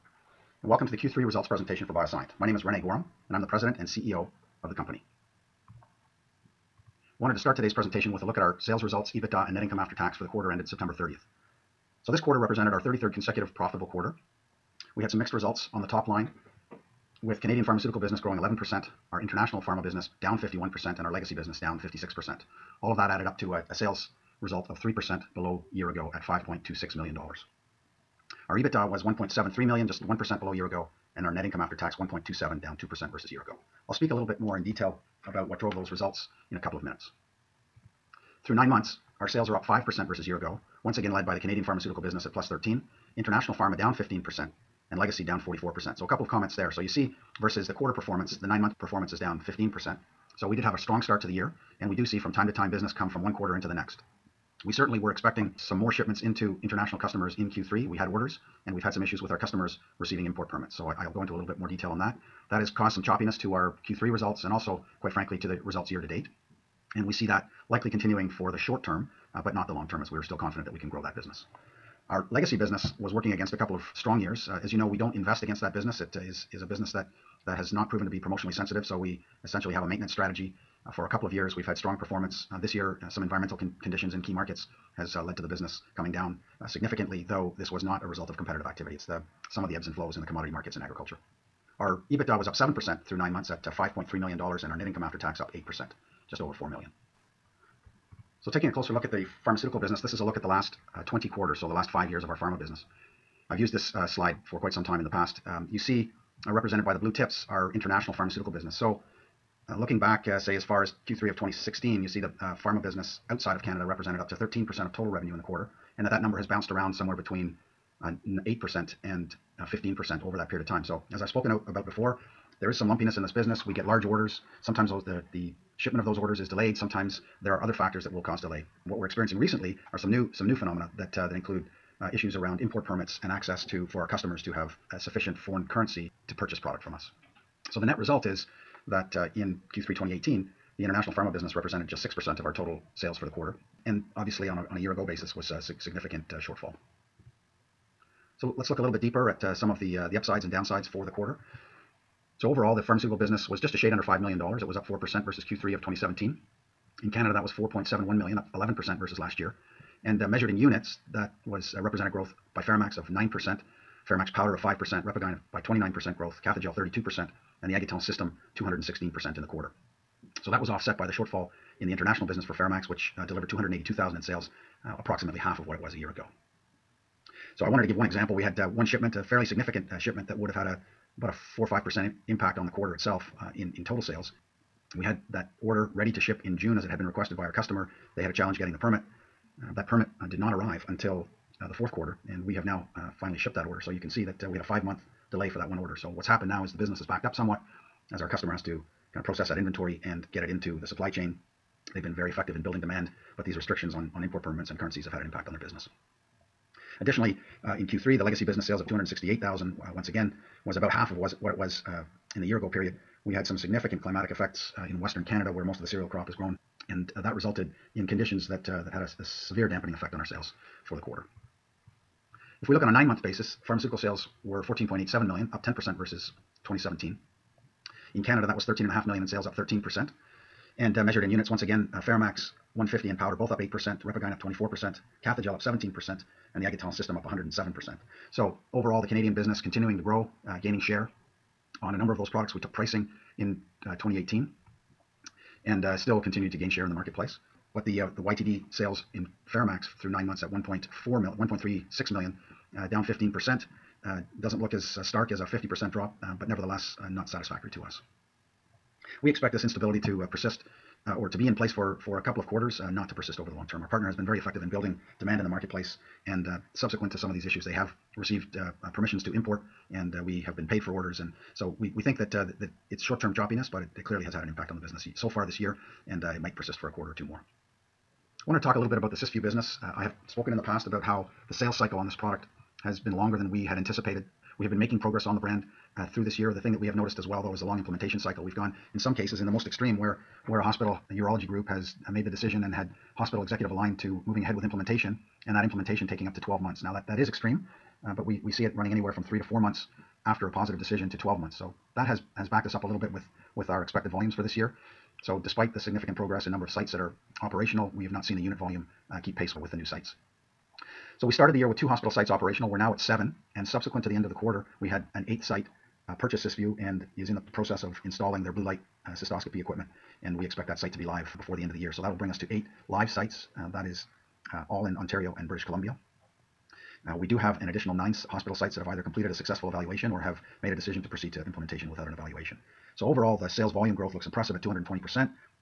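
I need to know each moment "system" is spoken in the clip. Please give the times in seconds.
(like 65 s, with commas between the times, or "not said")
168 s, 236 s.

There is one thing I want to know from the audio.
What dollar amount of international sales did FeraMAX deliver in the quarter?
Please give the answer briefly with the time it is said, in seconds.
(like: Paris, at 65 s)
282,000, at 173 s.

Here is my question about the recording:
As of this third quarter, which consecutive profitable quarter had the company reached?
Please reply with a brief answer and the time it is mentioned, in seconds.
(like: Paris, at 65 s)
33rd, at 12 s.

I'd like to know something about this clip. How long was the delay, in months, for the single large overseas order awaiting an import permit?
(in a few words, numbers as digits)
5 months.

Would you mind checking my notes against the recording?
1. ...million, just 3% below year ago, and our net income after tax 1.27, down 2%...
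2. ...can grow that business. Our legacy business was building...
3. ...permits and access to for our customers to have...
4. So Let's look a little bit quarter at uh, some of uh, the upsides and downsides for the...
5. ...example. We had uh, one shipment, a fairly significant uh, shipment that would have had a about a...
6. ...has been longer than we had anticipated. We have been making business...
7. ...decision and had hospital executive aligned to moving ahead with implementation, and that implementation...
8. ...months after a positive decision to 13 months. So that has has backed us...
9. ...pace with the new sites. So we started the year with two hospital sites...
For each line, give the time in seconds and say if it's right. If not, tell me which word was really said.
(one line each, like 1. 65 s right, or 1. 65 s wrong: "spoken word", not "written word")
1. 29 s wrong: "1", not "3"
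2. 70 s wrong: "working", not "building"
3. 132 s right
4. 148 s wrong: "deeper", not "quarter"
5. 178 s right
6. 282 s wrong: "progress", not "business"
7. 292 s right
8. 299 s wrong: "12", not "13"
9. 309 s right.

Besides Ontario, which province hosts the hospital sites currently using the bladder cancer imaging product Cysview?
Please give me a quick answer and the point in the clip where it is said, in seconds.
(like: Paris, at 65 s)
British Columbia, at 325 s.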